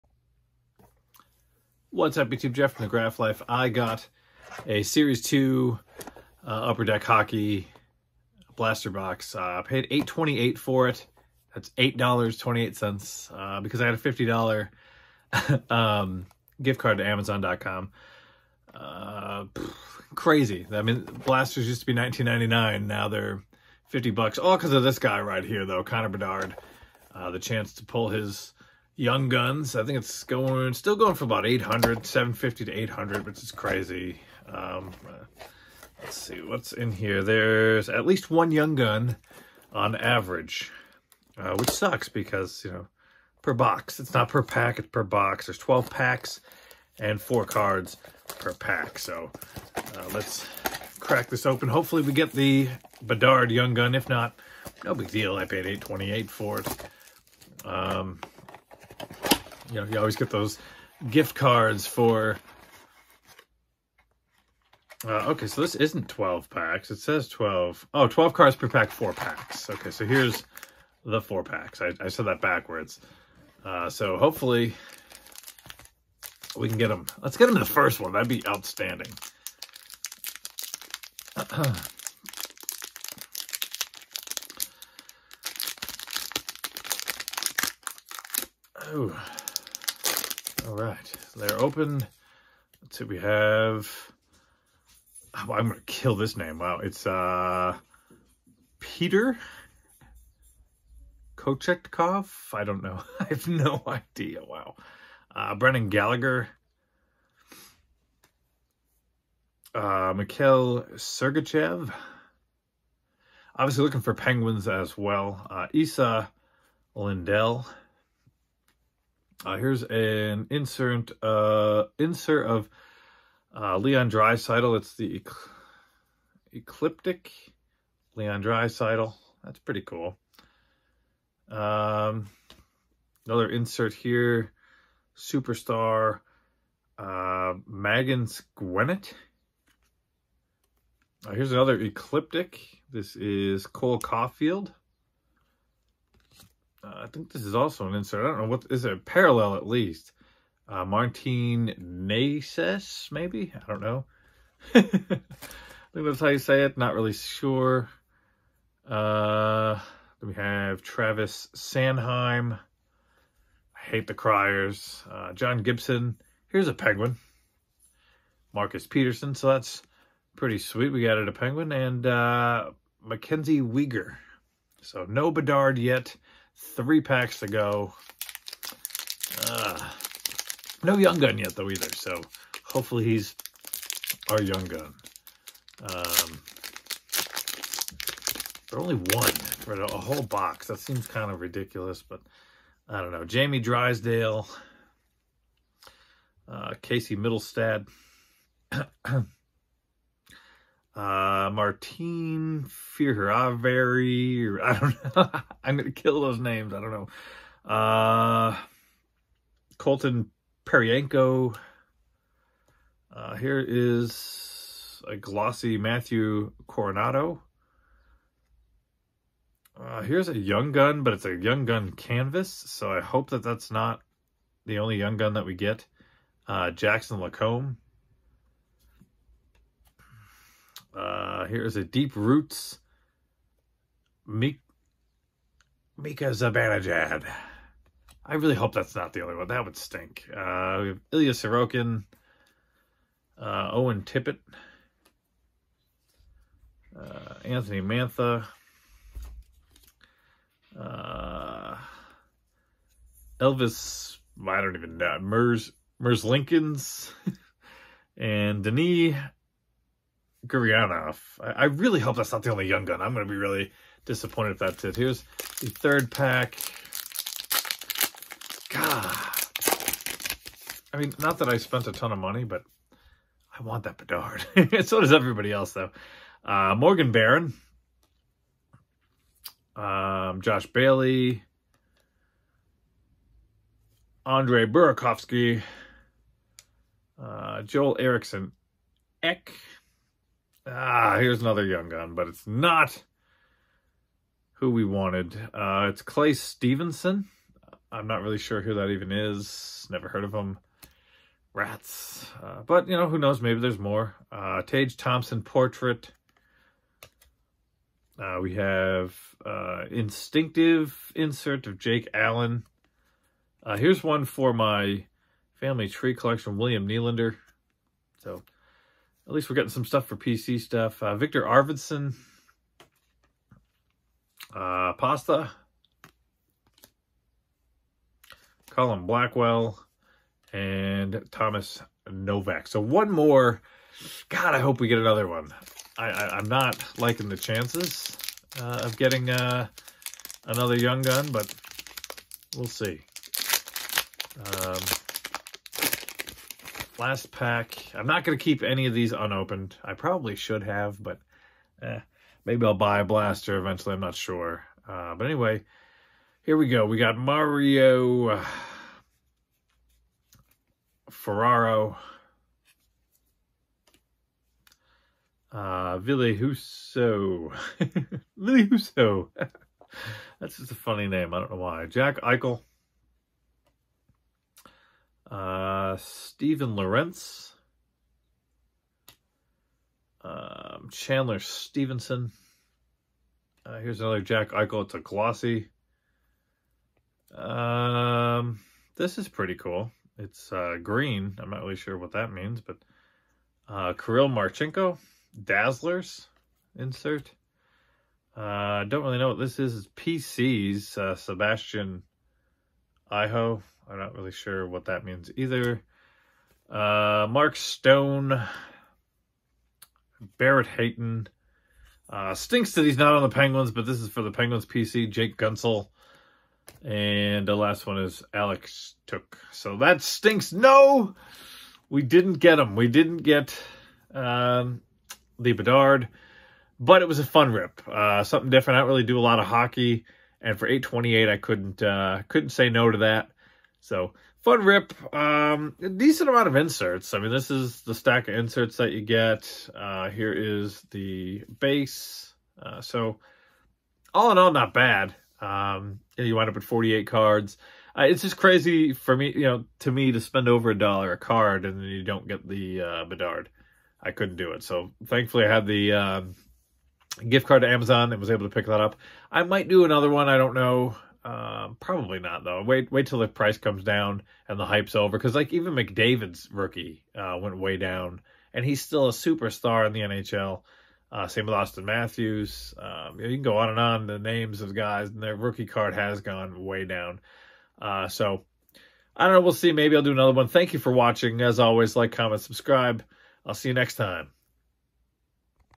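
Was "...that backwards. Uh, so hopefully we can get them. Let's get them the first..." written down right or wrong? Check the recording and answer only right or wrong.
right.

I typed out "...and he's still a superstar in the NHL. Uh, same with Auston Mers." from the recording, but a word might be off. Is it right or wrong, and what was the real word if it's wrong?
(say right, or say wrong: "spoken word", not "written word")
wrong: "Matthews", not "Mers".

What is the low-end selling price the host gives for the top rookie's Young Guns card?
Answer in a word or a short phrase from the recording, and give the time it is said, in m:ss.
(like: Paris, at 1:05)
750, at 0:32.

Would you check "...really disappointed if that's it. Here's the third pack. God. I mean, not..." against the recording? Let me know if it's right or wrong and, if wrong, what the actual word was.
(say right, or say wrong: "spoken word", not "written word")
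right.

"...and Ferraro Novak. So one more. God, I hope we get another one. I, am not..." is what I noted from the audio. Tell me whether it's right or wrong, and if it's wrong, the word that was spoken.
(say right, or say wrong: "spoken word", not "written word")
wrong: "Thomas", not "Ferraro".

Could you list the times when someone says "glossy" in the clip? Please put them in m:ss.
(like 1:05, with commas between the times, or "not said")
3:35, 6:24.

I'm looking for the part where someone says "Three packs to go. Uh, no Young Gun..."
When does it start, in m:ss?
2:56.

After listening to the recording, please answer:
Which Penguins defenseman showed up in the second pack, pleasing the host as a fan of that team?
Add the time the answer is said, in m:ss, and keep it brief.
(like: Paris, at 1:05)
Marcus Pettersson, at 2:48.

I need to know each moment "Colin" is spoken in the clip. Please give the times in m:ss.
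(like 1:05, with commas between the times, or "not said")
5:28.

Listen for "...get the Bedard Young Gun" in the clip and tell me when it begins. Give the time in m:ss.
0:52.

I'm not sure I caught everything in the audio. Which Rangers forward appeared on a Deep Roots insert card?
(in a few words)
Mika Zibanejad.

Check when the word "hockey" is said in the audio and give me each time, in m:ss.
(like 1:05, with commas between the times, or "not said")
0:07, 7:09.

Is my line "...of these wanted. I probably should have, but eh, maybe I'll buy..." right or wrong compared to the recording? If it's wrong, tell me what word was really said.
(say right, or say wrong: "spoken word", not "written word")
wrong: "unopened", not "wanted".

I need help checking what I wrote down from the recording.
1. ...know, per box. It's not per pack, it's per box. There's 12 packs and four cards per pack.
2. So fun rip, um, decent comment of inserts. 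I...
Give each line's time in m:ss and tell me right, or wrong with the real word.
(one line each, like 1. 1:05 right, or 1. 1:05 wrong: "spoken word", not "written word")
1. 0:42 right
2. 7:13 wrong: "amount", not "comment".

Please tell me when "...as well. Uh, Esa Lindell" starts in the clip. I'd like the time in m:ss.
1:54.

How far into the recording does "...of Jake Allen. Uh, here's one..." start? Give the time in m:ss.
5:11.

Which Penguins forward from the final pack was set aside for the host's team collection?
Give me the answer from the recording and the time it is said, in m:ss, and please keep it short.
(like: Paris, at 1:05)
Jake Guentzel, at 6:55.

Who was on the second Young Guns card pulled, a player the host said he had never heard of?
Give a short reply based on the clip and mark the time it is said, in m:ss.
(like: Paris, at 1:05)
Clay Stevenson, at 4:56.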